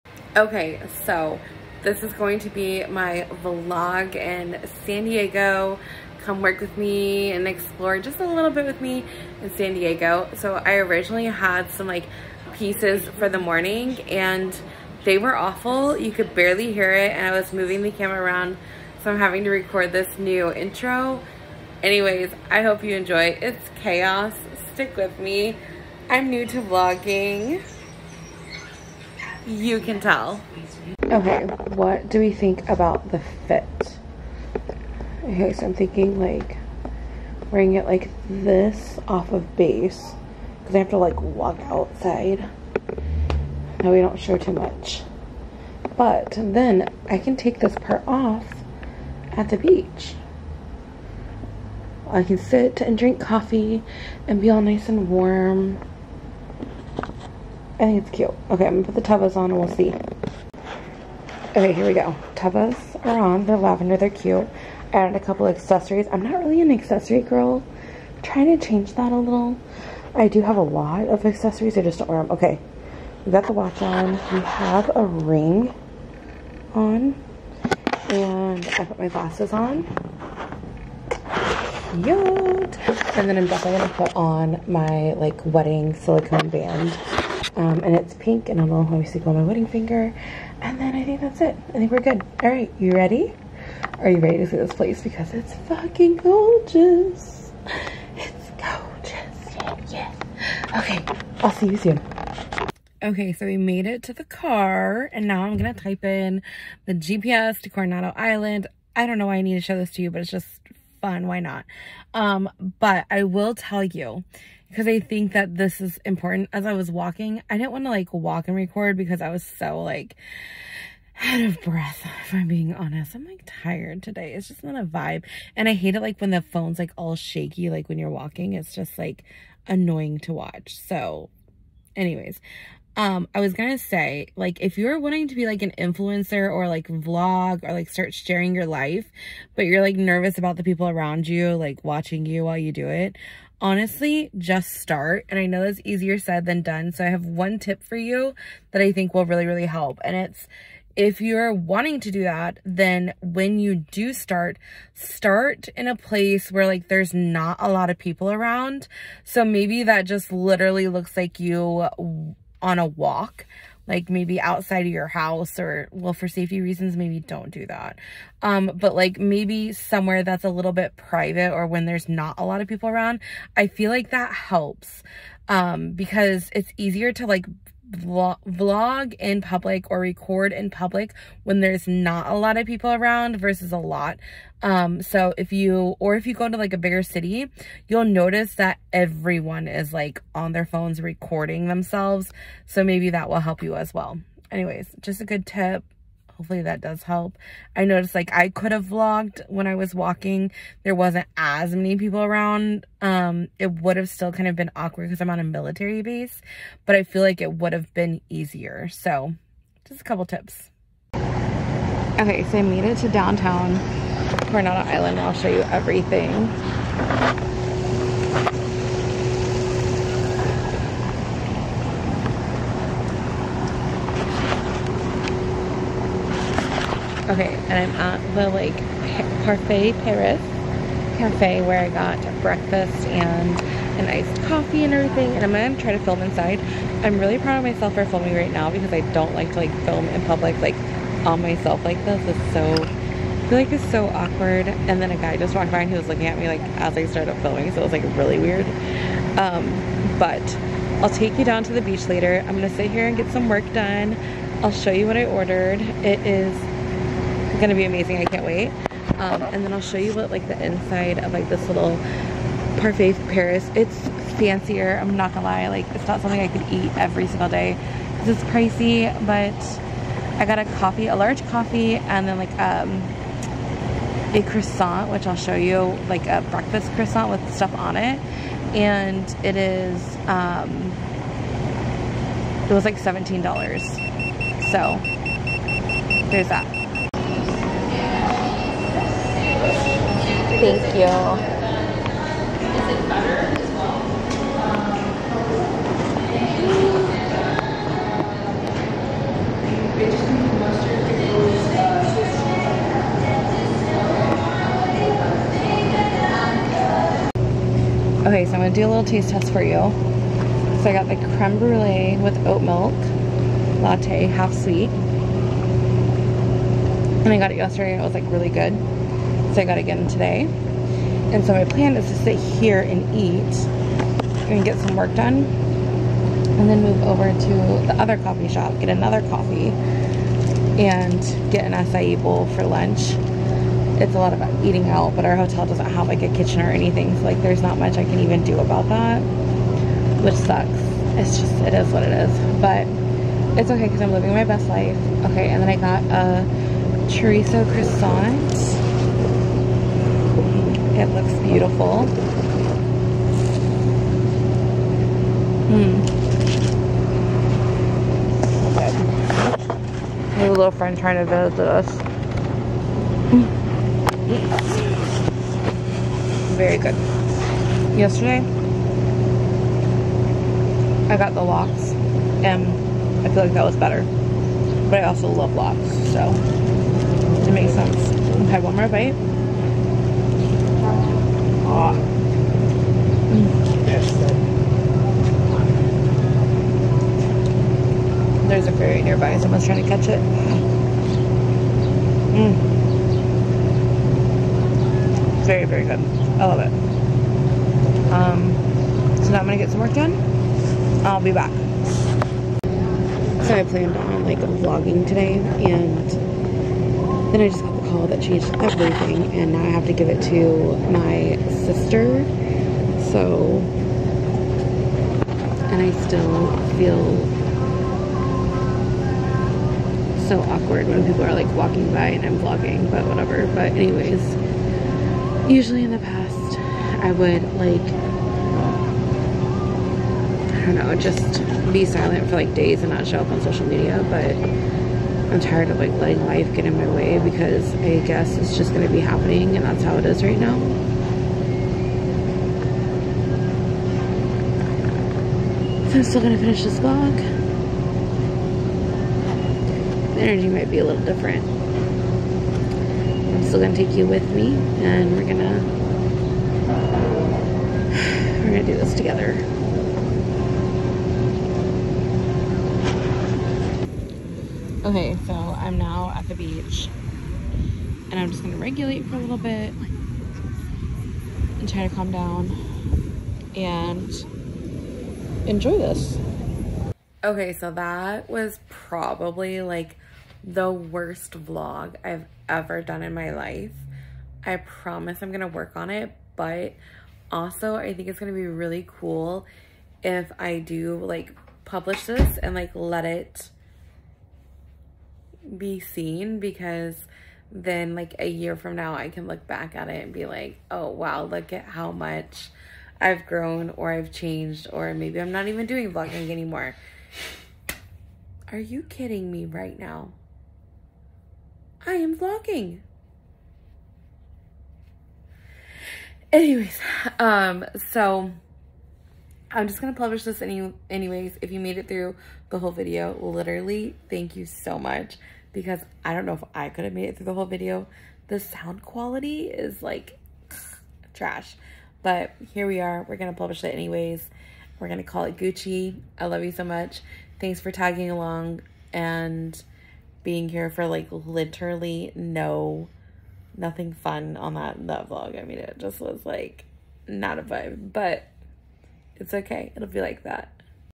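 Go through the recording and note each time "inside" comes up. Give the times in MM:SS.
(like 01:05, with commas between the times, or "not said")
03:56, 04:20.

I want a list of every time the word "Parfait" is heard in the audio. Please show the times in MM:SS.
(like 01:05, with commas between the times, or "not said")
03:49, 04:22.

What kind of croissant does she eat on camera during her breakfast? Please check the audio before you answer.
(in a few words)
Chorizo.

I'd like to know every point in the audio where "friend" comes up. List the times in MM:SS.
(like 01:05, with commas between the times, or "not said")
06:00.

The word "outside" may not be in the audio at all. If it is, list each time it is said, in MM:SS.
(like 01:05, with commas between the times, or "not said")
00:41, 02:44.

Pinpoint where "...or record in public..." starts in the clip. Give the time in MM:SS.
02:59.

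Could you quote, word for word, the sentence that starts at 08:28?
Are you kidding me right now?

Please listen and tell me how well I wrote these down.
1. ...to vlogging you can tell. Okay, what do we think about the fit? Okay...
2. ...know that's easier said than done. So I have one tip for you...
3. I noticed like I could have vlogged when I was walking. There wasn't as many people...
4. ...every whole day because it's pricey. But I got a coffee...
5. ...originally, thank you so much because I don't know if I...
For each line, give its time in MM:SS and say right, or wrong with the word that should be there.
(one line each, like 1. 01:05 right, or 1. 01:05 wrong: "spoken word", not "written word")
1. 00:26 right
2. 02:25 right
3. 03:17 right
4. 04:26 wrong: "single", not "whole"
5. 08:43 wrong: "literally", not "originally".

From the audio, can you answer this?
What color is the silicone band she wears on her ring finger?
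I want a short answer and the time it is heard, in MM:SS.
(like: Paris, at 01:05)
Pink, at 01:27.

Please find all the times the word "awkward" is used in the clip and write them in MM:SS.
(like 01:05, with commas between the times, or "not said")
03:24, 04:04, 07:00.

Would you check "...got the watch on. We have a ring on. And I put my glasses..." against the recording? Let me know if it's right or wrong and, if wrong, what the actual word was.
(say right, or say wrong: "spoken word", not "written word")
right.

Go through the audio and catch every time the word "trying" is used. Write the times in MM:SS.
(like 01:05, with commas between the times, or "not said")
01:08, 06:00, 06:29.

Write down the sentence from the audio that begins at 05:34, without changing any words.
It's a lot about eating out, but our hotel doesn't have like a kitchen or anything.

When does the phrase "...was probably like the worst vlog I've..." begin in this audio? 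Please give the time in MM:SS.
07:58.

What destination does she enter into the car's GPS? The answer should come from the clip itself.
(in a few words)
Coronado Island.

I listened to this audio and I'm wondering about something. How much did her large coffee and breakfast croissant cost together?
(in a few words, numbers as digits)
$17.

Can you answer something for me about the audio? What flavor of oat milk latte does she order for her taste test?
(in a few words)
Creme brulee.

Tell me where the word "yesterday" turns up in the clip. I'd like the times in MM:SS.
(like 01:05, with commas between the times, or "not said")
05:17, 06:07.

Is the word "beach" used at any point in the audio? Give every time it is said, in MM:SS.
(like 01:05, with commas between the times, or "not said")
00:49, 04:11, 07:46.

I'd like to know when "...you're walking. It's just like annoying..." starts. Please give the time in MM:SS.
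02:07.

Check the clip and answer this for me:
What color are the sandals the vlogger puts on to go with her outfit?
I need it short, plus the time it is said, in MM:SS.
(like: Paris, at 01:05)
Lavender, at 01:03.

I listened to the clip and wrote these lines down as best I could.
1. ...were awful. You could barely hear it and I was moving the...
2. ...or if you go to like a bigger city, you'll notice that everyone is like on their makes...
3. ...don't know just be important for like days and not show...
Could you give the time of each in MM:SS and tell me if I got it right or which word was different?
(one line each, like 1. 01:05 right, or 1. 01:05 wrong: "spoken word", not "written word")
1. 00:15 right
2. 03:05 wrong: "phones", not "makes"
3. 07:10 wrong: "silent", not "important".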